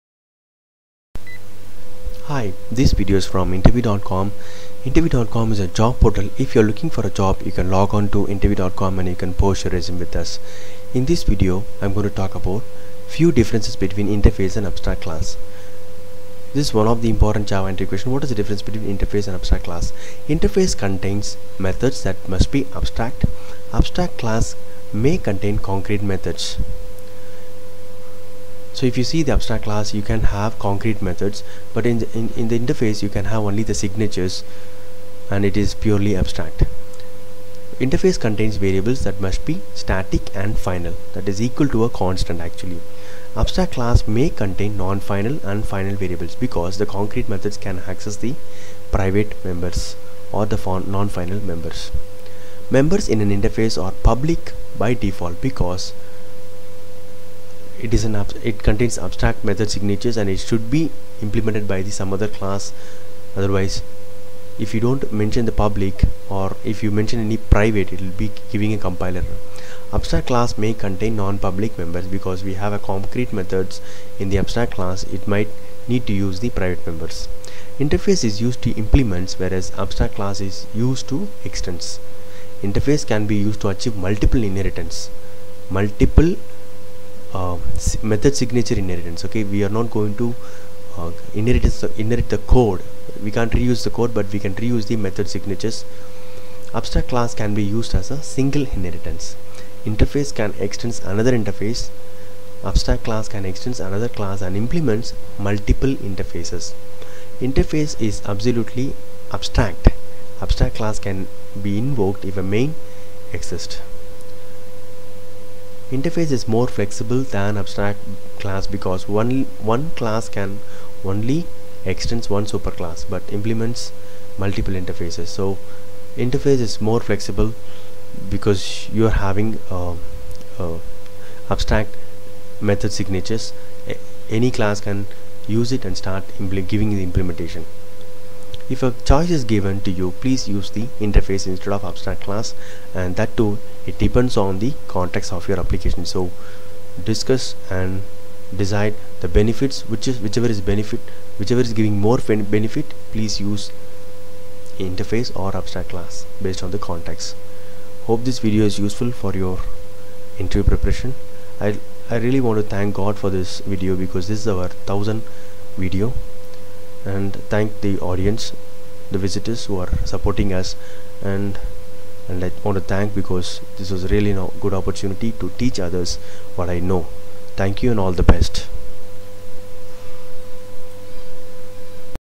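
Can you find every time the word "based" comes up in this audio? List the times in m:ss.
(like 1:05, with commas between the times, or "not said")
2:36.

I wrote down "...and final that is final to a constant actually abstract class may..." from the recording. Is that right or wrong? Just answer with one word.
wrong.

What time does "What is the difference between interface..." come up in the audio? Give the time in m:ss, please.
0:18.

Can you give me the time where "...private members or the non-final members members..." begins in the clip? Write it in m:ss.
0:48.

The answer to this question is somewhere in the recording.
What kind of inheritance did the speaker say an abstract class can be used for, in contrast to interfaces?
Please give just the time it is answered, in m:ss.
1:38.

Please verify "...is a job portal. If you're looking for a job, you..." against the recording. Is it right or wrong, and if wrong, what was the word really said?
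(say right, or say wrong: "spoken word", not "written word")
right.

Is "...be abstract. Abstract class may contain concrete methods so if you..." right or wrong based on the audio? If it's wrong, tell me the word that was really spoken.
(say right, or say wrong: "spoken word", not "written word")
right.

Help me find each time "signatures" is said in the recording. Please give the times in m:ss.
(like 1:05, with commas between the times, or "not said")
0:33, 0:59, 1:28, 1:35, 2:13.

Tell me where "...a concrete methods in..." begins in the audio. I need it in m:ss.
1:12.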